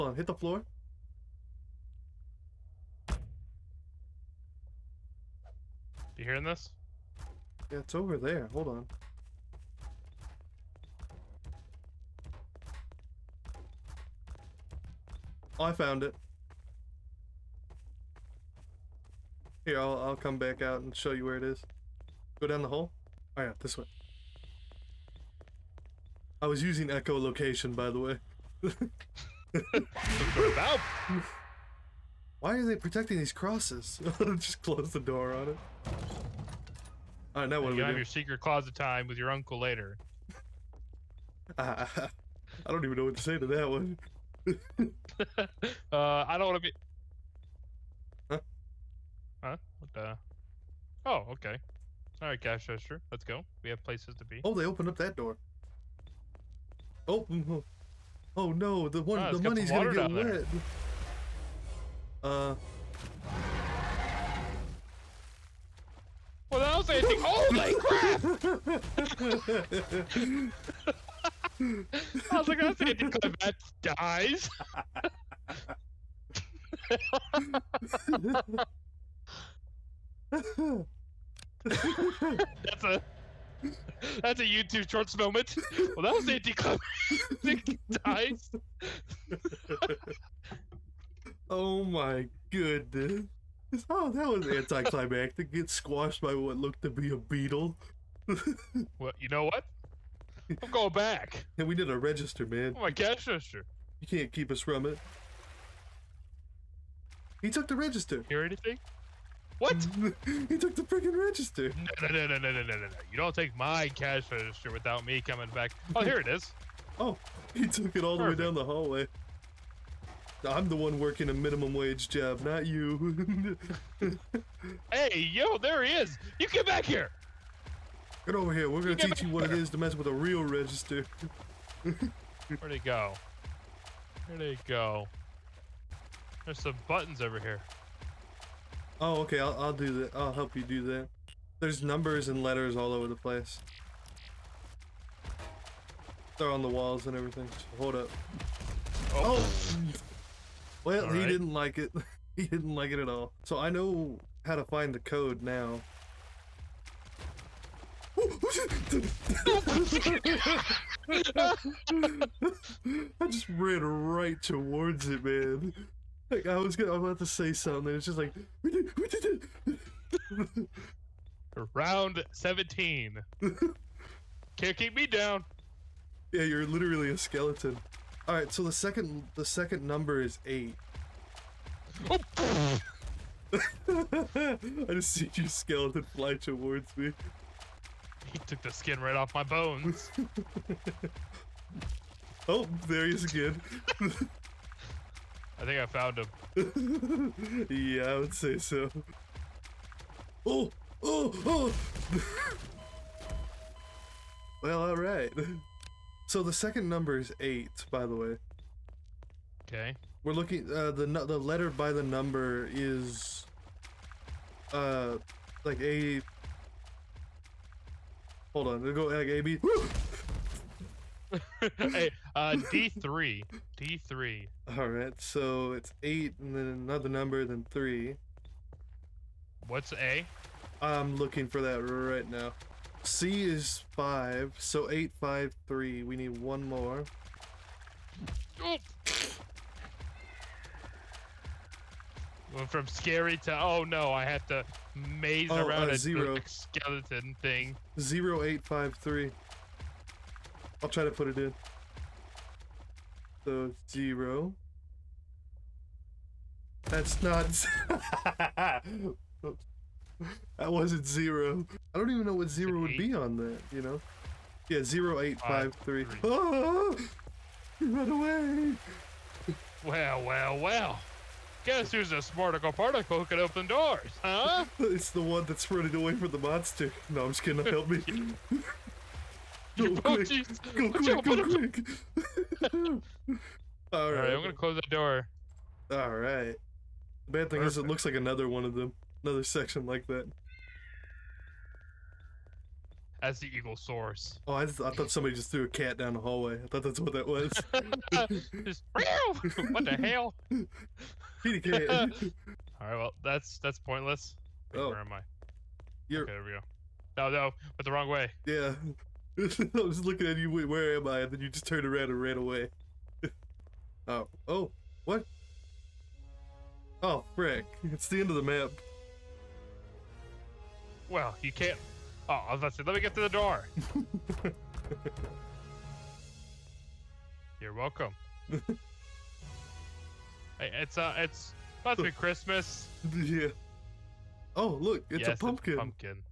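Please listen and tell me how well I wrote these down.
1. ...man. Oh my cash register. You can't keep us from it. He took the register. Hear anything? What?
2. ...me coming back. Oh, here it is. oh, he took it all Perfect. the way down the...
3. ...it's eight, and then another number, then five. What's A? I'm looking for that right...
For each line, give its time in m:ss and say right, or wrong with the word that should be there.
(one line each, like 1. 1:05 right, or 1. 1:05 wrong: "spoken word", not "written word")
1. 1:42 right
2. 1:55 right
3. 3:45 wrong: "three", not "five".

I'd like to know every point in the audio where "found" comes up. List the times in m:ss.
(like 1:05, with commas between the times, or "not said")
0:15, 3:15.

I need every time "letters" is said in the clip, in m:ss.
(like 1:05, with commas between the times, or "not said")
2:22, 3:31.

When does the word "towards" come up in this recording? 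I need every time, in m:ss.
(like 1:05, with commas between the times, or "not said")
2:44, 3:06.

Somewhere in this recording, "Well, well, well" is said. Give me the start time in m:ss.
4:29.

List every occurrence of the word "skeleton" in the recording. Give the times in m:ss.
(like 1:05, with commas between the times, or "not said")
2:57, 3:05, 4:06.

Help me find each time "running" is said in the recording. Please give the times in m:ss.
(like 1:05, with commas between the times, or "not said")
4:35.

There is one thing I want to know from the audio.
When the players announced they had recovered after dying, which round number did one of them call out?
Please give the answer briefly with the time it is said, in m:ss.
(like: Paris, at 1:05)
17, at 2:51.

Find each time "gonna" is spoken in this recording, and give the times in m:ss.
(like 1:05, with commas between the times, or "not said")
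0:59, 2:46, 4:44.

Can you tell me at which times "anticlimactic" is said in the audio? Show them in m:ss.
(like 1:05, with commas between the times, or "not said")
1:26, 1:34.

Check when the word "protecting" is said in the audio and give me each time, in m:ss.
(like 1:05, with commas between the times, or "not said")
0:32.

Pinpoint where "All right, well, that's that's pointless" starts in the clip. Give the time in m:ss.
5:01.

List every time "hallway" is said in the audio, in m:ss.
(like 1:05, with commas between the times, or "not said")
1:58, 4:56.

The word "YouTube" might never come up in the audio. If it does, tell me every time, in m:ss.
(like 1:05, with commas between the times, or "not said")
1:24.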